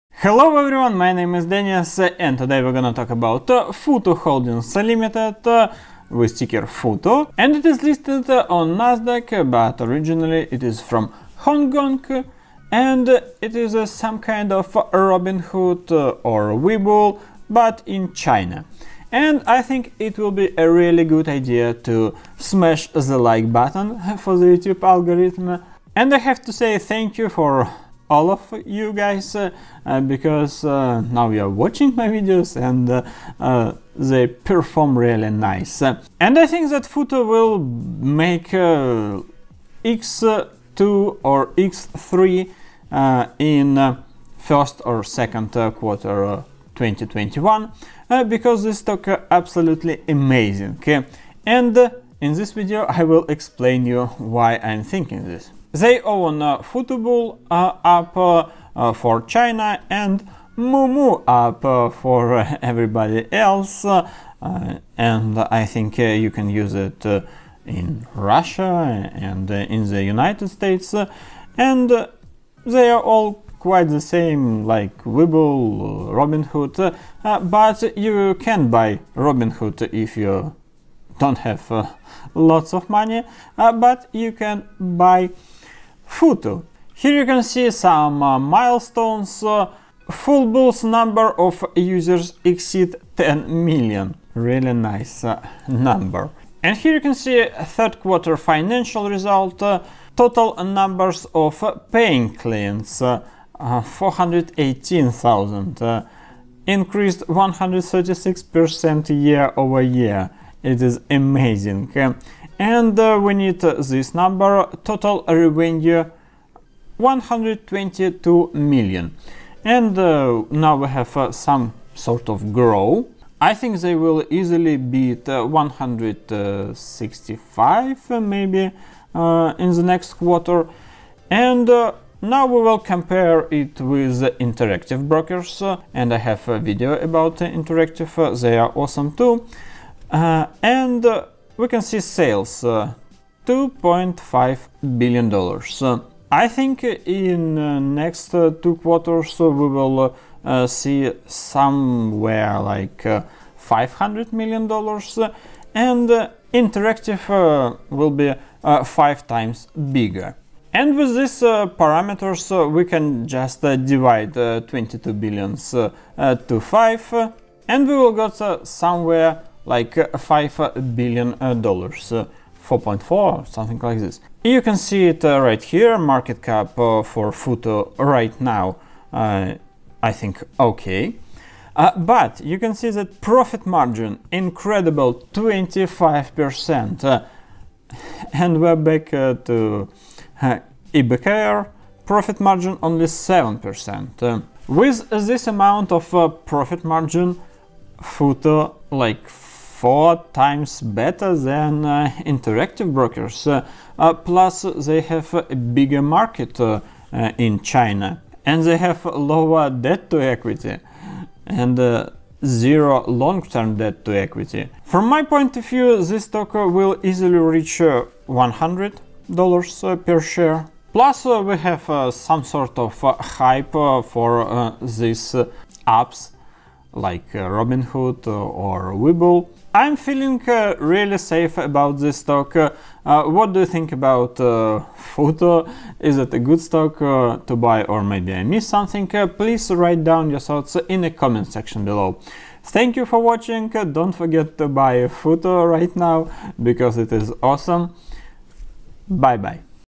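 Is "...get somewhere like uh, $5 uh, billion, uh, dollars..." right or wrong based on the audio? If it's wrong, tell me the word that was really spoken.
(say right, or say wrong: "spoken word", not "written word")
right.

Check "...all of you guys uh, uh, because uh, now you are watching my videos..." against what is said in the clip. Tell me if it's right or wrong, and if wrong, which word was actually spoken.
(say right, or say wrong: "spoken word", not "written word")
right.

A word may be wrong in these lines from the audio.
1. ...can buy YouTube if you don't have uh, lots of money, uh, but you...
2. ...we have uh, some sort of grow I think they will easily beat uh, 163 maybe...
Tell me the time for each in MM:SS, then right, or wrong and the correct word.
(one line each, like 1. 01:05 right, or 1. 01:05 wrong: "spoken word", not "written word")
1. 01:18 wrong: "Robinhood", not "YouTube"
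2. 02:00 wrong: "165", not "163".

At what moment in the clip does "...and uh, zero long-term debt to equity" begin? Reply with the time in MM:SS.
03:31.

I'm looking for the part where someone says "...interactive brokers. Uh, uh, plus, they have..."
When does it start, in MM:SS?
03:22.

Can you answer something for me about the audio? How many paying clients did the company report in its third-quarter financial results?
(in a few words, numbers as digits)
418,000.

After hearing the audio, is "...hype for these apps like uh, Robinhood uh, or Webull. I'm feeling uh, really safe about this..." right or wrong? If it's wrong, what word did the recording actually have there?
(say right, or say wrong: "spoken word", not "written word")
right.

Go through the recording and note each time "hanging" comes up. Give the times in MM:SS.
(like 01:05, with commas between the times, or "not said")
not said.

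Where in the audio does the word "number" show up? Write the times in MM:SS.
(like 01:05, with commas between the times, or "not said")
01:30, 01:35, 01:40, 01:54.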